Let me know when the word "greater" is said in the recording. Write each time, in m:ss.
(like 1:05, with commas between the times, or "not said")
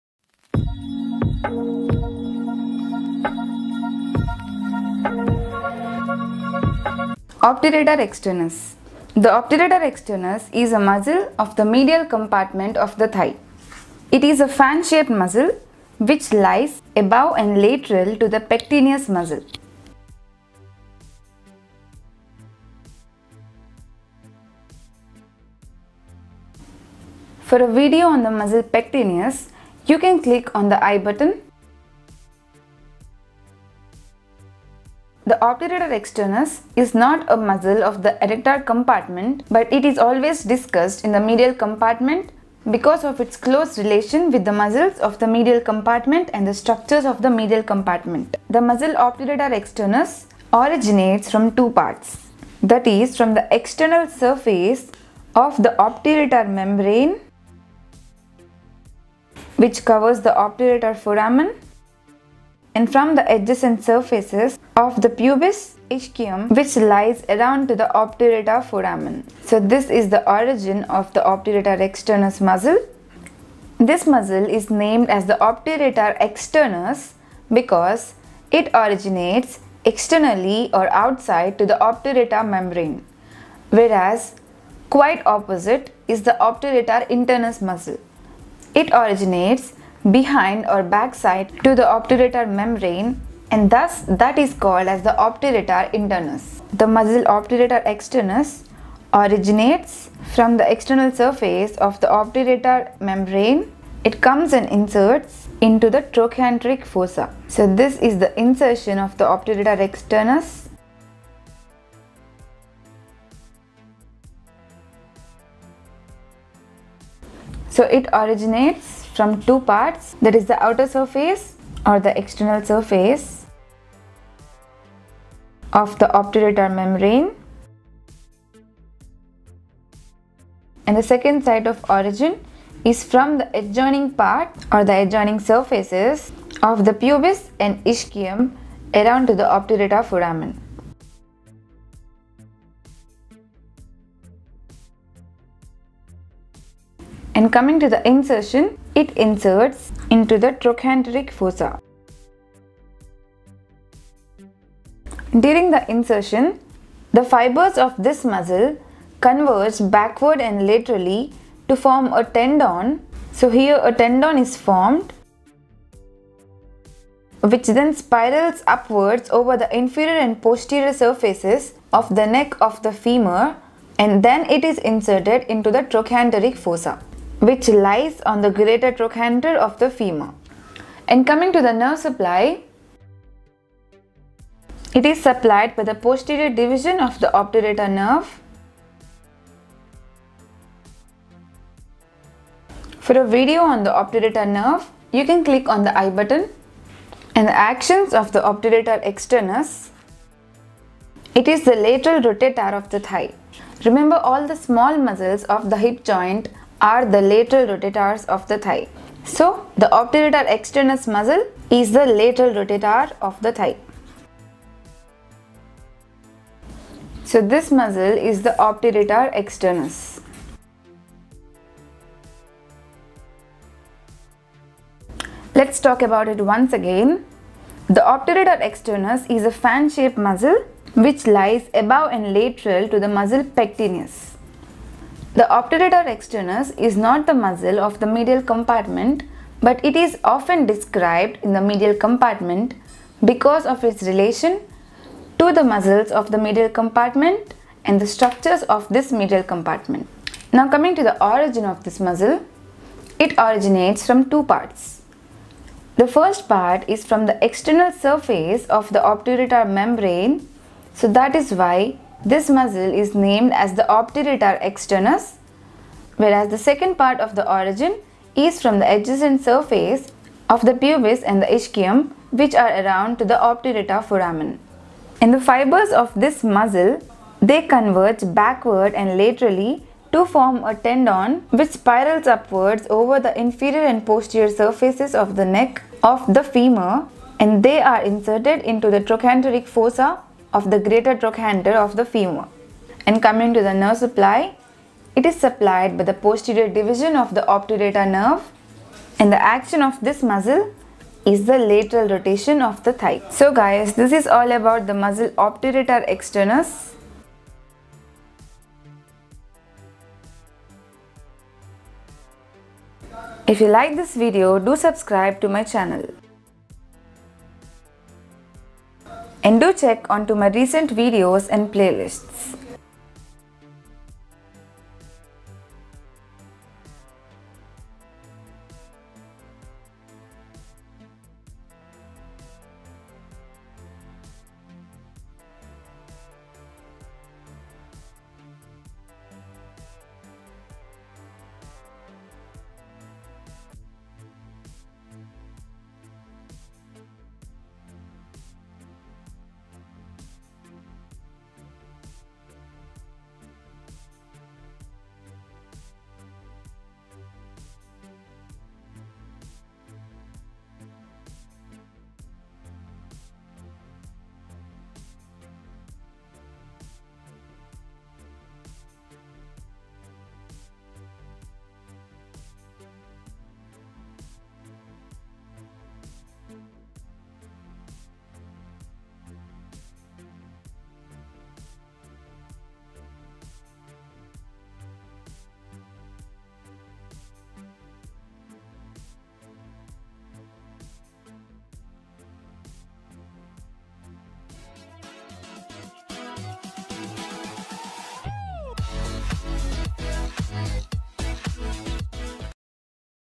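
2:58, 4:50.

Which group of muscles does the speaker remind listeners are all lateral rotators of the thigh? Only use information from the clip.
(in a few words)
small muscles of the hip joint.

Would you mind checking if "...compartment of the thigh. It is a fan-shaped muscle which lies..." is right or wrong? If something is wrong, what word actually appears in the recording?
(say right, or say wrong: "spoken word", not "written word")
right.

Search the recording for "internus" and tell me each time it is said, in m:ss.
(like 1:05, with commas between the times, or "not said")
1:27, 1:35.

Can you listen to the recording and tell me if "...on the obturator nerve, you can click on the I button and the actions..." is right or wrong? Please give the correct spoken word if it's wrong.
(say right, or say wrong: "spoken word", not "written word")
right.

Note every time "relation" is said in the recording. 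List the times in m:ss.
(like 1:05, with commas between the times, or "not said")
0:43, 4:04.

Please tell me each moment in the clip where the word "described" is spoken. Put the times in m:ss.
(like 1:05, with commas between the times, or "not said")
4:00.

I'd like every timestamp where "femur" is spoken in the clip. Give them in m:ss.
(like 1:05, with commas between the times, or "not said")
2:52, 2:59, 4:46, 4:52.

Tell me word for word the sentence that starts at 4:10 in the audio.
Now coming to the origin of this muscle, it originates from two parts.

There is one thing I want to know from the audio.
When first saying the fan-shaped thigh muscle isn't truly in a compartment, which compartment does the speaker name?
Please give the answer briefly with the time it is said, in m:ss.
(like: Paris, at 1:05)
adductor compartment, at 0:38.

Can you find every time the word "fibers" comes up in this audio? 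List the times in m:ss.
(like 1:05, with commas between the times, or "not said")
2:37, 4:35.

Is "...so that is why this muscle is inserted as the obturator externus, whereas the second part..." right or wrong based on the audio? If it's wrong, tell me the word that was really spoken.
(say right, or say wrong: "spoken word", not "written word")
wrong: "named", not "inserted".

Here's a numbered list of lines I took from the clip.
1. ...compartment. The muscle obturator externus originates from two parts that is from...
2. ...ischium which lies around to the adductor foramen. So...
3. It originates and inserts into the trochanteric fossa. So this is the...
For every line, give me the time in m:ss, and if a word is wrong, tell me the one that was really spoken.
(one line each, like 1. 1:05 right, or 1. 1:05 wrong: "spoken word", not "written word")
1. 0:47 right
2. 1:05 wrong: "obturator", not "adductor"
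3. 1:44 wrong: "comes", not "originates".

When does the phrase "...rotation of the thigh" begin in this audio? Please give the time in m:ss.
5:02.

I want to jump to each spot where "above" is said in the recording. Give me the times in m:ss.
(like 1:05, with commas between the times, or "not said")
0:16, 3:51.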